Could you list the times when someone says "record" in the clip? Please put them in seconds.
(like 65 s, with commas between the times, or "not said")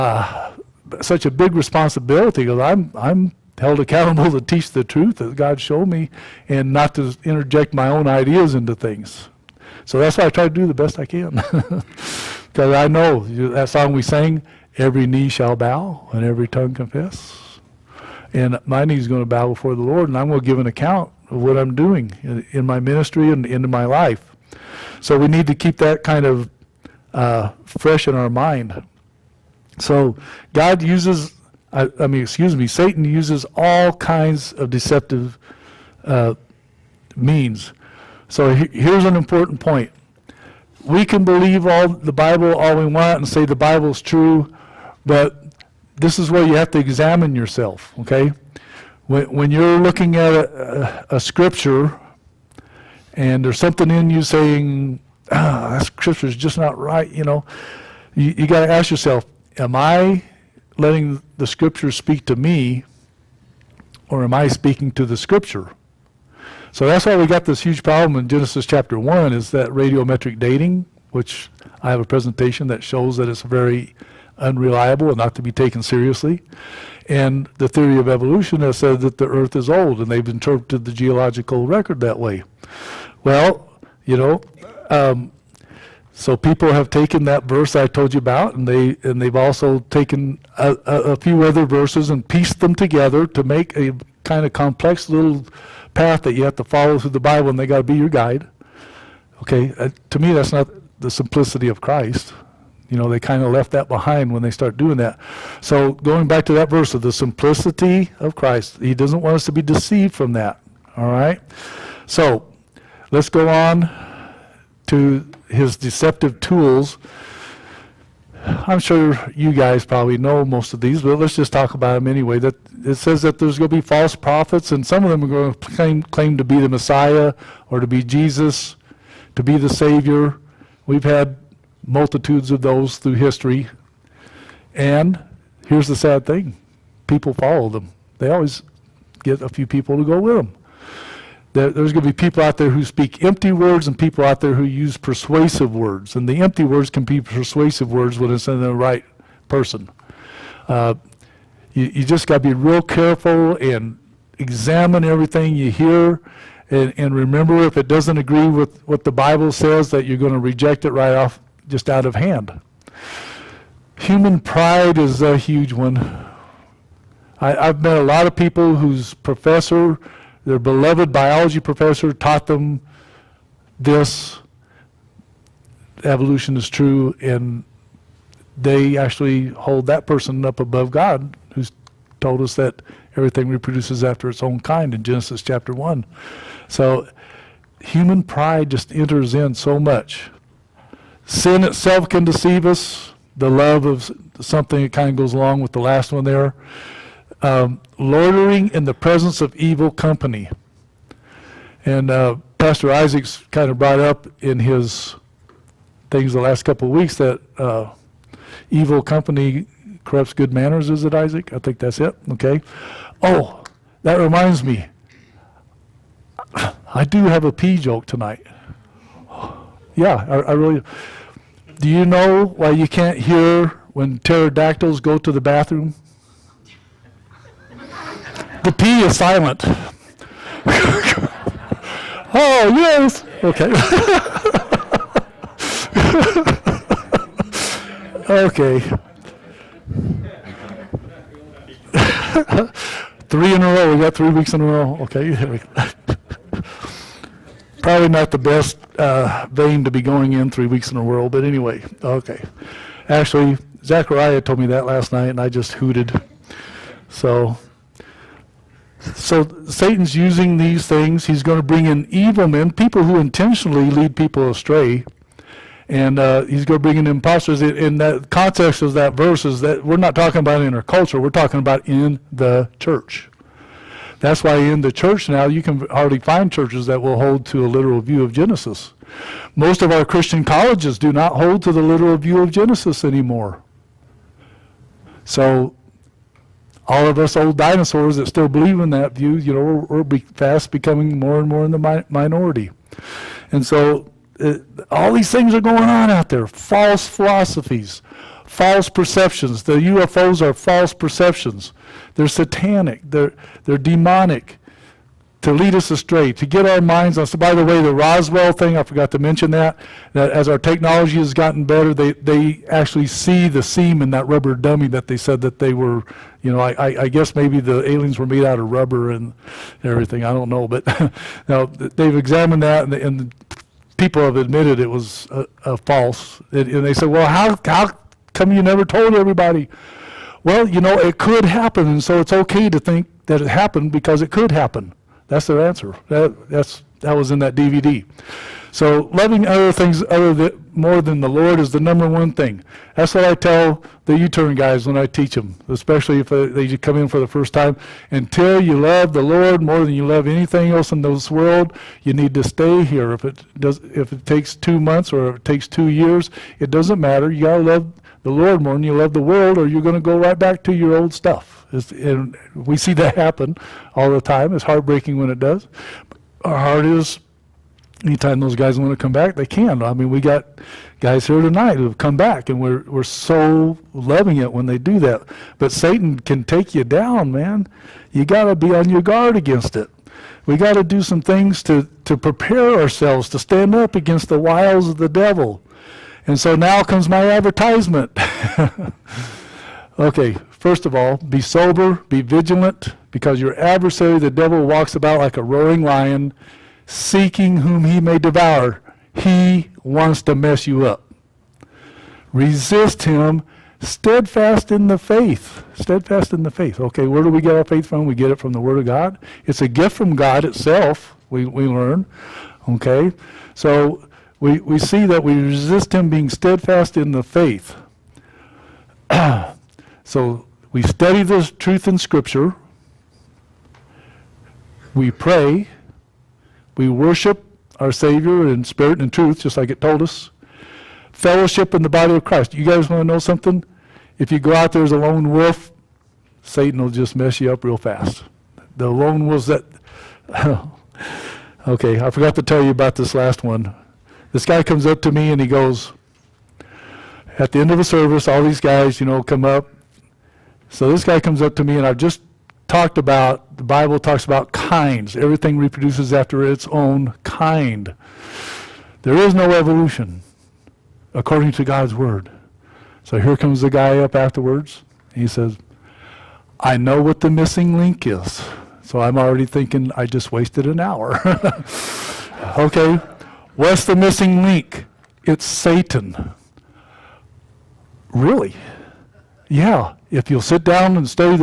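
81 s.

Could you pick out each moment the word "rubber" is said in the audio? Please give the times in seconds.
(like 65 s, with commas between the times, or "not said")
314 s, 318 s.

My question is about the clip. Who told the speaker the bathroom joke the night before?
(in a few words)
Zachariah.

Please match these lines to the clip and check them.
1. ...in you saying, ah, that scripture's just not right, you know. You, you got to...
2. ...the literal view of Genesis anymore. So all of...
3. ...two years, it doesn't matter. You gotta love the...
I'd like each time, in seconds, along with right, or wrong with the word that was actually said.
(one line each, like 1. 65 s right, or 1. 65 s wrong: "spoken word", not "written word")
1. 53 s right
2. 281 s right
3. 355 s right.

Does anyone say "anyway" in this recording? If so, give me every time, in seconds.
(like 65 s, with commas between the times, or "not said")
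122 s, 251 s.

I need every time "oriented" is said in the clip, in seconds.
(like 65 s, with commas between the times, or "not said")
not said.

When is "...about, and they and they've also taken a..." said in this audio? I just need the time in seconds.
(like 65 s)
88 s.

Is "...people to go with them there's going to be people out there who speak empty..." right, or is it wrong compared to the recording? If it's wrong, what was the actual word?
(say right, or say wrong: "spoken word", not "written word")
right.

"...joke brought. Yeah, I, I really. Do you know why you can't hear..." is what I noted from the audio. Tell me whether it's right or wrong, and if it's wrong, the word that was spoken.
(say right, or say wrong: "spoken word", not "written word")
wrong: "tonight", not "brought".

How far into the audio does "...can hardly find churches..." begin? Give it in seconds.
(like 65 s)
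275 s.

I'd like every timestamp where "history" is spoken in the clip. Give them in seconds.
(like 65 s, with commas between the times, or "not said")
133 s.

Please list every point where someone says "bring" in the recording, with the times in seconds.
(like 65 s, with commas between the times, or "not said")
261 s, 266 s.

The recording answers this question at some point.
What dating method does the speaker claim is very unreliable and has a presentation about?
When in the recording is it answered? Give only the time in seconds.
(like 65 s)
69 s.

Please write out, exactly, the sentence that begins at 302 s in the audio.
They're satanic, they're, they're demonic to lead us astray, to get our minds on.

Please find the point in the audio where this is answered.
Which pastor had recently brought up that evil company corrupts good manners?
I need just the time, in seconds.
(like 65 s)
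202 s.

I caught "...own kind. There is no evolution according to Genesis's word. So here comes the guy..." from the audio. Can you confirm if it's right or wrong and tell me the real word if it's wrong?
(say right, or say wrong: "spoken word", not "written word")
wrong: "God", not "Genesis".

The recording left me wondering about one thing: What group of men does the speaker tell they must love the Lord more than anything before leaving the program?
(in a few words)
The U-turn guys.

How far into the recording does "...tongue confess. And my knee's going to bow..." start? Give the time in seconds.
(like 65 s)
16 s.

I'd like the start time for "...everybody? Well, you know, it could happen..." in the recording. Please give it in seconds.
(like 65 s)
329 s.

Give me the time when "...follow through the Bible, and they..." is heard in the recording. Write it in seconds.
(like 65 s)
96 s.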